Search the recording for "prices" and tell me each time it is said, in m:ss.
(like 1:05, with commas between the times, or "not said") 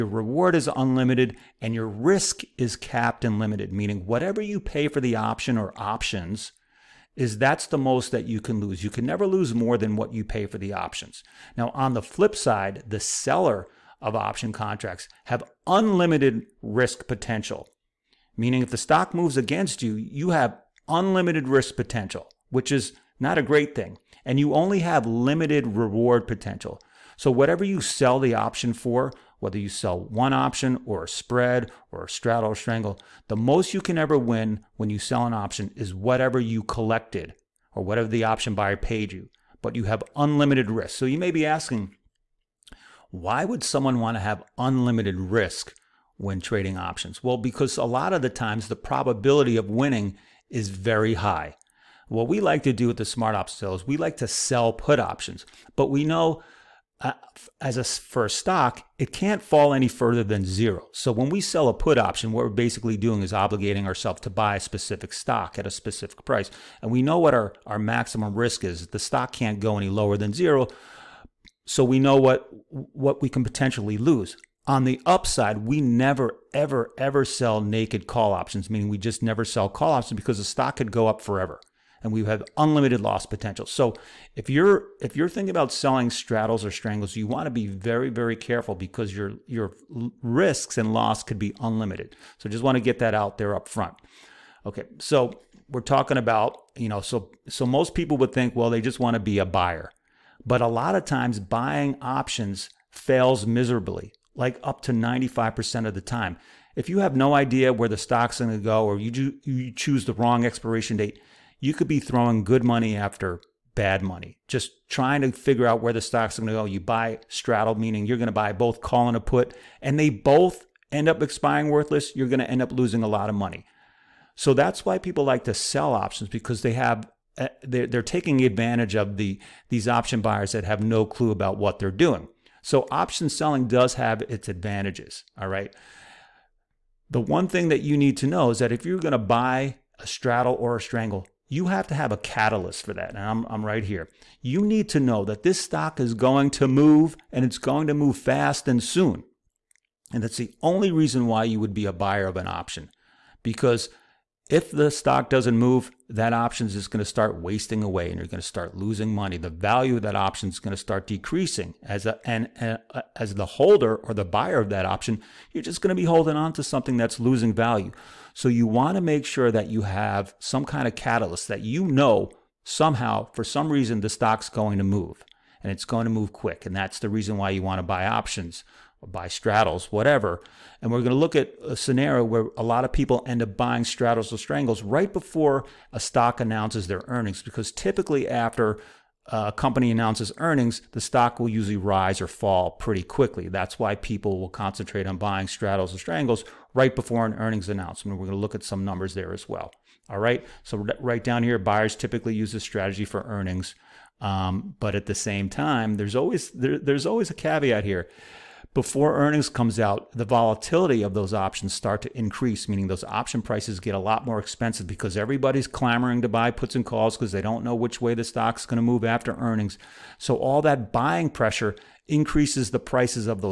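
1:06, 3:33, 3:42.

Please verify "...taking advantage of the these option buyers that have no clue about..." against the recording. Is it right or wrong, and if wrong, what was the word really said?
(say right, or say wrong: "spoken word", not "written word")
right.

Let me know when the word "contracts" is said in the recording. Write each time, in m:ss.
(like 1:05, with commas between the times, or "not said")
0:14.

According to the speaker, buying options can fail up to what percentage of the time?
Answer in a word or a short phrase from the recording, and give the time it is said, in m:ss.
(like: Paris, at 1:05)
95%, at 1:44.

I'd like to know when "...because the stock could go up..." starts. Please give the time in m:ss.
1:20.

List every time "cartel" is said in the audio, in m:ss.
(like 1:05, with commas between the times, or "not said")
not said.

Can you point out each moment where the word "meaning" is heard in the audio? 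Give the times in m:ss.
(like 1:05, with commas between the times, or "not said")
0:03, 0:18, 1:18, 1:57, 3:32.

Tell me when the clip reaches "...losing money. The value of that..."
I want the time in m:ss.
2:38.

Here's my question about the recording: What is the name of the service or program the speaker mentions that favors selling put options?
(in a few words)
Smart Option Seller.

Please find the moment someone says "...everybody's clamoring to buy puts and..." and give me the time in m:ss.
3:35.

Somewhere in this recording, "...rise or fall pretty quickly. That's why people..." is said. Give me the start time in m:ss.
3:11.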